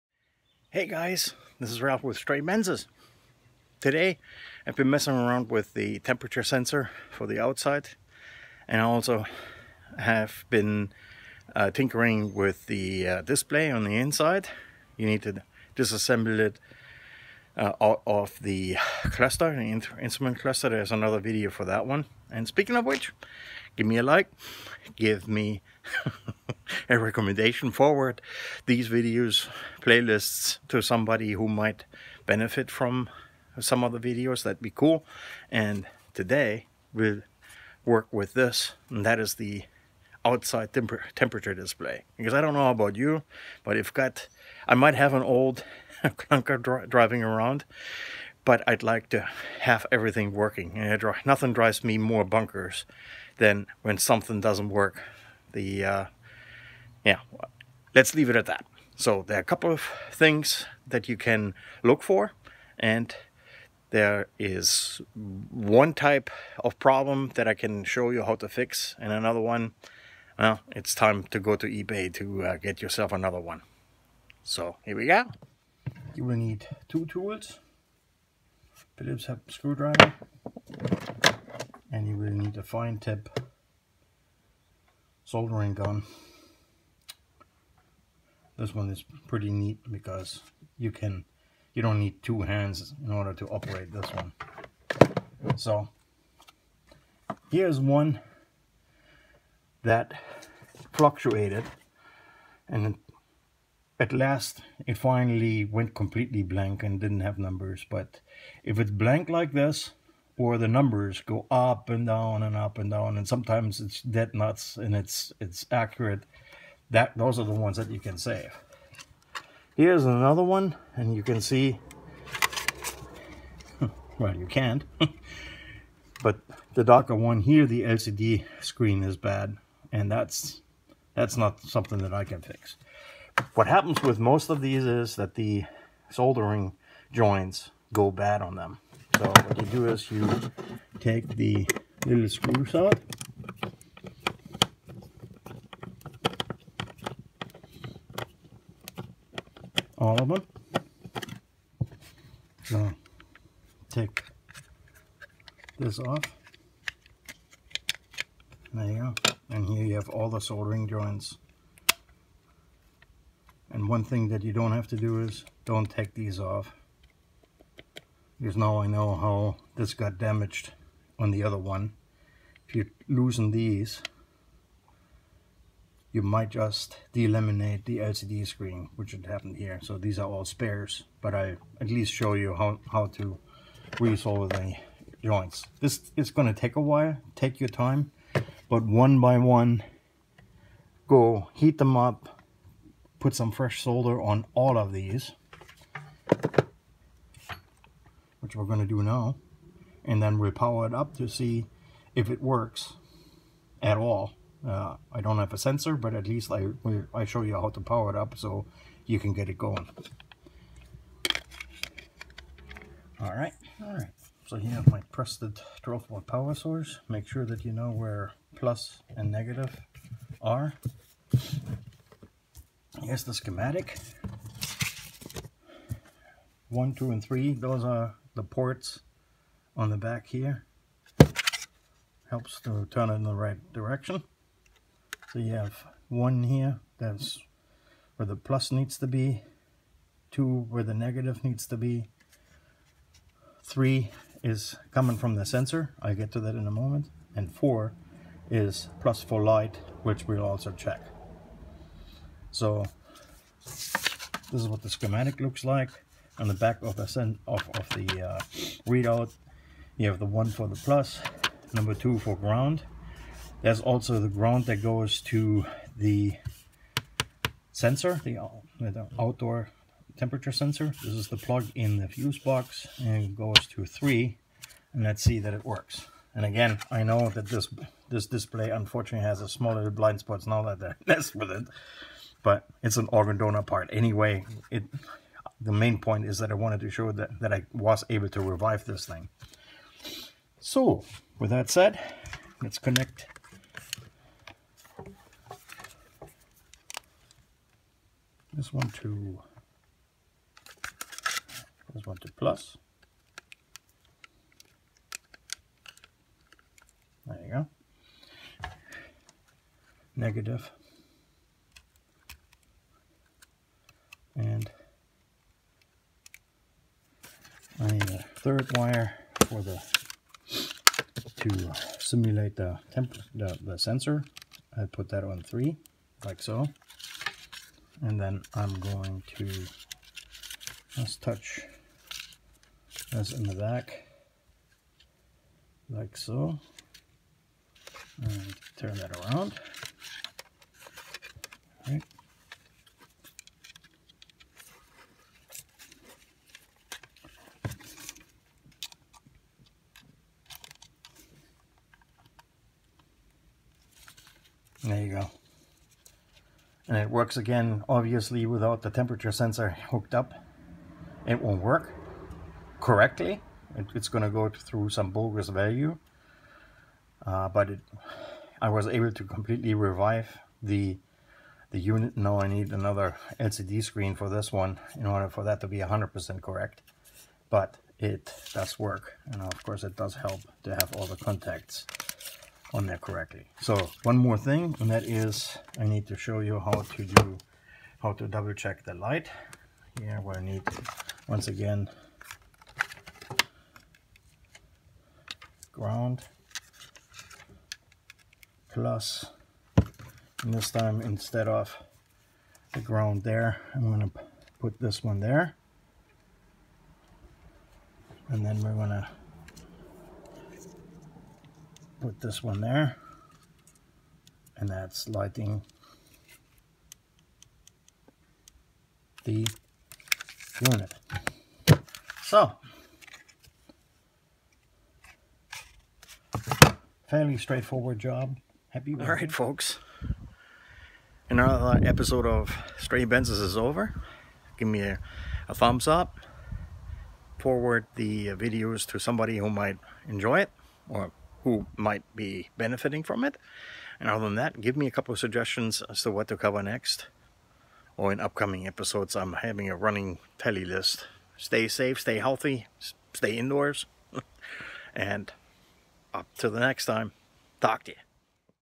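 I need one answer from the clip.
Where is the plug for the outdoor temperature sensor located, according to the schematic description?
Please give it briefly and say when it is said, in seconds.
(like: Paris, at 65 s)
the fuse box, at 272 s.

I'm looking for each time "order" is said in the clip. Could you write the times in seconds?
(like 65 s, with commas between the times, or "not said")
93 s, 375 s.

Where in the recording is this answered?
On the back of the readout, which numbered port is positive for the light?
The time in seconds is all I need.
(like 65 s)
247 s.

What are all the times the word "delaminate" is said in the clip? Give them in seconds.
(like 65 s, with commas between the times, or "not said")
177 s.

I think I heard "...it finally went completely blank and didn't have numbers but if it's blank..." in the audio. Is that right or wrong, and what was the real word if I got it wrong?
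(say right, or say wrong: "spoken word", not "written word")
right.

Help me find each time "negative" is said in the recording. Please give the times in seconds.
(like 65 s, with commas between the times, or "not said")
219 s, 240 s, 310 s.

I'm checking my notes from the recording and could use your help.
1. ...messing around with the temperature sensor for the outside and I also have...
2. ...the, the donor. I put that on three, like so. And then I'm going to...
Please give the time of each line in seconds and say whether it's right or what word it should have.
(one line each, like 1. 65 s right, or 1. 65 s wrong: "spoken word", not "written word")
1. 4 s right
2. 323 s wrong: "sensor", not "donor".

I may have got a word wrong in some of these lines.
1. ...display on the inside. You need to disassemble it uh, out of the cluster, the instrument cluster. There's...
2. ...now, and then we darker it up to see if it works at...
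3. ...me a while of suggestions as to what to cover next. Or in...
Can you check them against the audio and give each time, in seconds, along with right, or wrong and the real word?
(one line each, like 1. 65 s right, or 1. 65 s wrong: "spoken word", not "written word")
1. 13 s right
2. 199 s wrong: "power", not "darker"
3. 444 s wrong: "couple", not "while".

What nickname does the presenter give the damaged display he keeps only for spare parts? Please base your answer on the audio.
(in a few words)
organ donor part.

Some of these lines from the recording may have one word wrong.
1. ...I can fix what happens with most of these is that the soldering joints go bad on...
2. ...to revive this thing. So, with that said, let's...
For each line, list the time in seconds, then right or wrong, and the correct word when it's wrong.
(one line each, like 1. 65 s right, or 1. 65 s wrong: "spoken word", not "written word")
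1. 132 s right
2. 288 s right.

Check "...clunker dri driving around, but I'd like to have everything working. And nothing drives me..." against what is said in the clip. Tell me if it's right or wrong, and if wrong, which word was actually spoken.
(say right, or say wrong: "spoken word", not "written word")
right.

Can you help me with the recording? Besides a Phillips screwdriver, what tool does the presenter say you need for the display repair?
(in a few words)
fine tip soldering gun.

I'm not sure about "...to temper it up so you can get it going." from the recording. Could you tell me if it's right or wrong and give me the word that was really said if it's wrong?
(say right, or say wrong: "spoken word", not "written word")
wrong: "power", not "temper".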